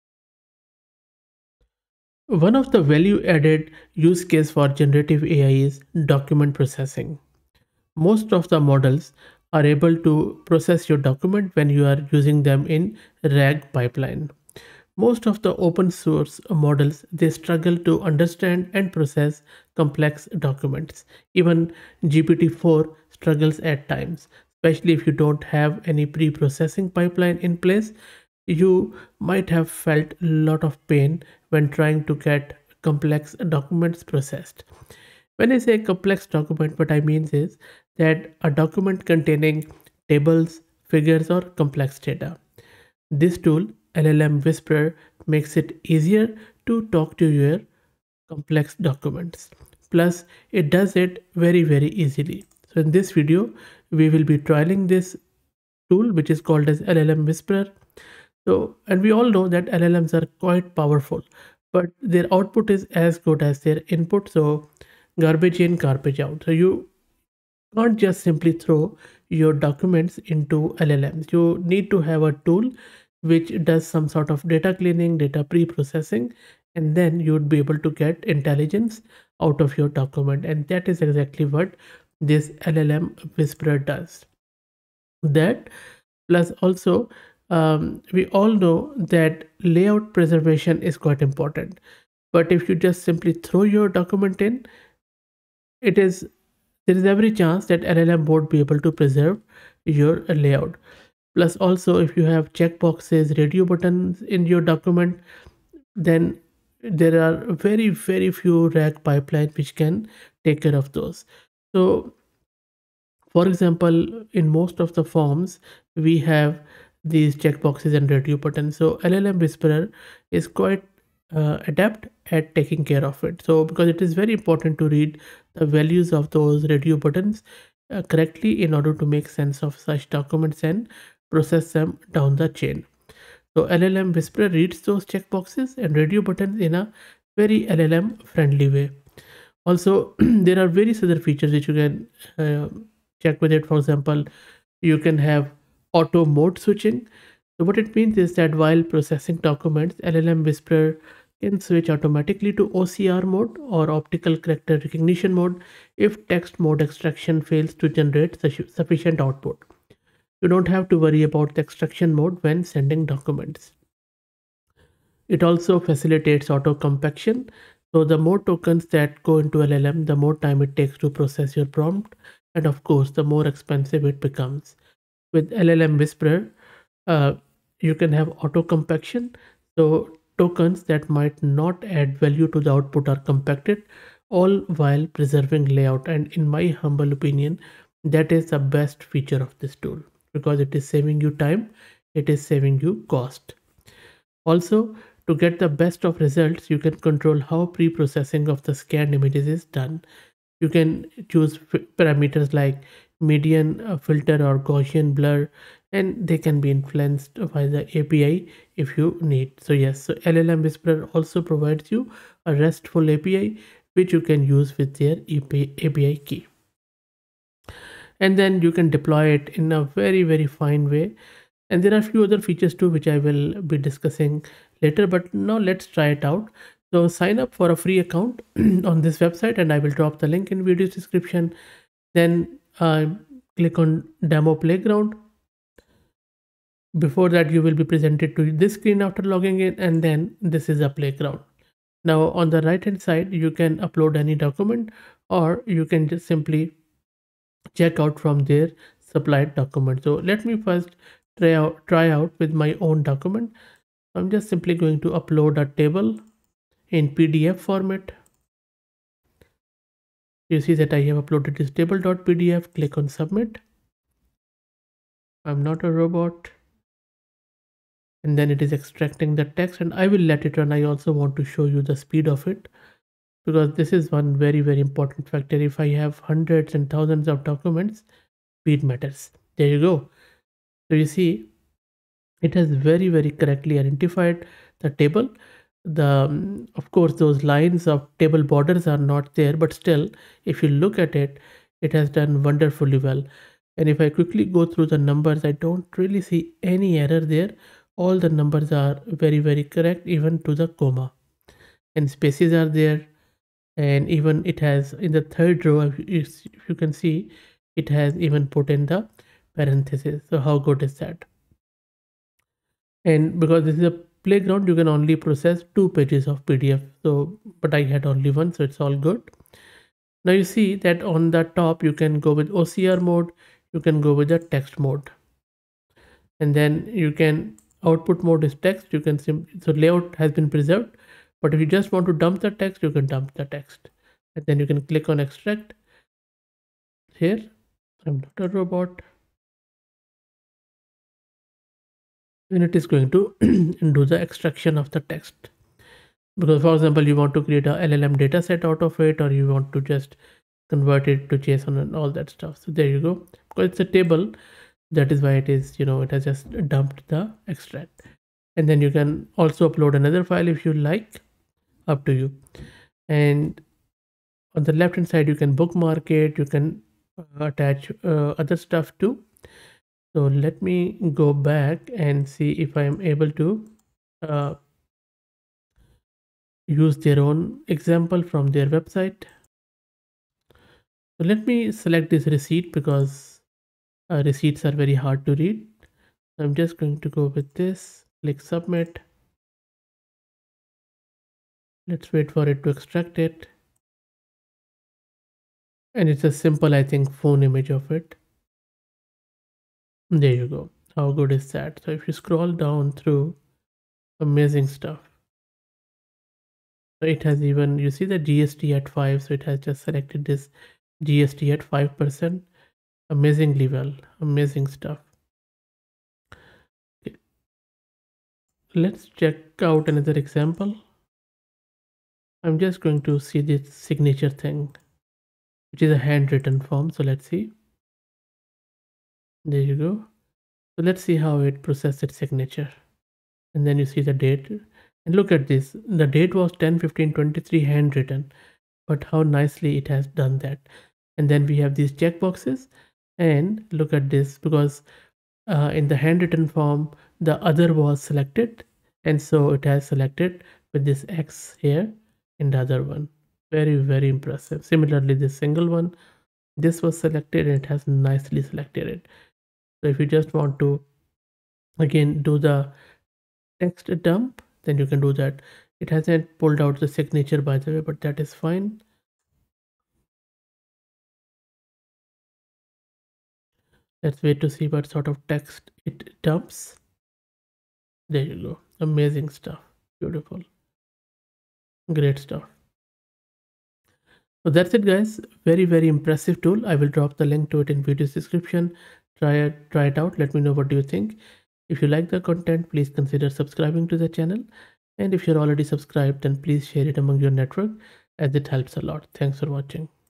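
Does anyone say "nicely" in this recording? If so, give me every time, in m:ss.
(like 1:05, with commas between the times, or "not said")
7:19, 7:37.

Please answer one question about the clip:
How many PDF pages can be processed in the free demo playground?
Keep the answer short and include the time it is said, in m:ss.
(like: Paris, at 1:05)
2, at 5:15.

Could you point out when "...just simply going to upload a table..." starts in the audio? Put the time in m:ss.
4:14.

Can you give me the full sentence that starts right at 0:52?
So in this video, we will be trialing this tool, which is called as LLM Whisperer.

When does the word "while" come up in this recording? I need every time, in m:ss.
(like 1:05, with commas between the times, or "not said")
2:28, 3:04.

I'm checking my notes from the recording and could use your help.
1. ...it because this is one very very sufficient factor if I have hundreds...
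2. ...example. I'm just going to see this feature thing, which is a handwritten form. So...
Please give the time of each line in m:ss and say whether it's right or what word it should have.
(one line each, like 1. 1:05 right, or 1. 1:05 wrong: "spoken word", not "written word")
1. 4:32 wrong: "important", not "sufficient"
2. 7:00 wrong: "signature", not "feature".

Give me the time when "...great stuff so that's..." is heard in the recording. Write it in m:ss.
8:01.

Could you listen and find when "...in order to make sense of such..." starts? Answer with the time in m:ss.
2:08.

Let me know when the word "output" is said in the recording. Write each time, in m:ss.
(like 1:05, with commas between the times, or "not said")
1:02, 2:39, 3:02, 5:27.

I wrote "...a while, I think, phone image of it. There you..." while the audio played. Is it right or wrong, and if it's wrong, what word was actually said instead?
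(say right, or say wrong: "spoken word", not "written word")
wrong: "simple", not "while".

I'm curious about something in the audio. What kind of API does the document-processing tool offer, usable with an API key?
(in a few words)
RESTful API.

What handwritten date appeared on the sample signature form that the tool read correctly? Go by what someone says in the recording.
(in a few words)
10 15 23.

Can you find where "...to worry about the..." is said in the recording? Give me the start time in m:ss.
2:40.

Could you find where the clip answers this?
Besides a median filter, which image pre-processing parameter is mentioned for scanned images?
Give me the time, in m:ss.
3:24.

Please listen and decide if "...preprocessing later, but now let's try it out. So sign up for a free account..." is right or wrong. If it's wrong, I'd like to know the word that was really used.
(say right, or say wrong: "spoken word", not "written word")
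wrong: "discussing", not "preprocessing".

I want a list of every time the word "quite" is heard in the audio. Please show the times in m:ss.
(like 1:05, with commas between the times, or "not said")
1:00, 1:30, 2:00.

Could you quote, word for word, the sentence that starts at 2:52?
And of course, the more expensive it becomes with LLM Whisperer, uh, you can have auto compaction.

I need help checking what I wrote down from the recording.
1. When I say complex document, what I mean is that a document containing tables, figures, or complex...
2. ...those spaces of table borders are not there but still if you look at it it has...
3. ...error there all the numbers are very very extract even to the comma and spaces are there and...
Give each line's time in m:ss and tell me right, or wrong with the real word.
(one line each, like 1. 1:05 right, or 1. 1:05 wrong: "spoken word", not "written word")
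1. 0:35 right
2. 4:47 wrong: "lines", not "spaces"
3. 4:56 wrong: "correct", not "extract".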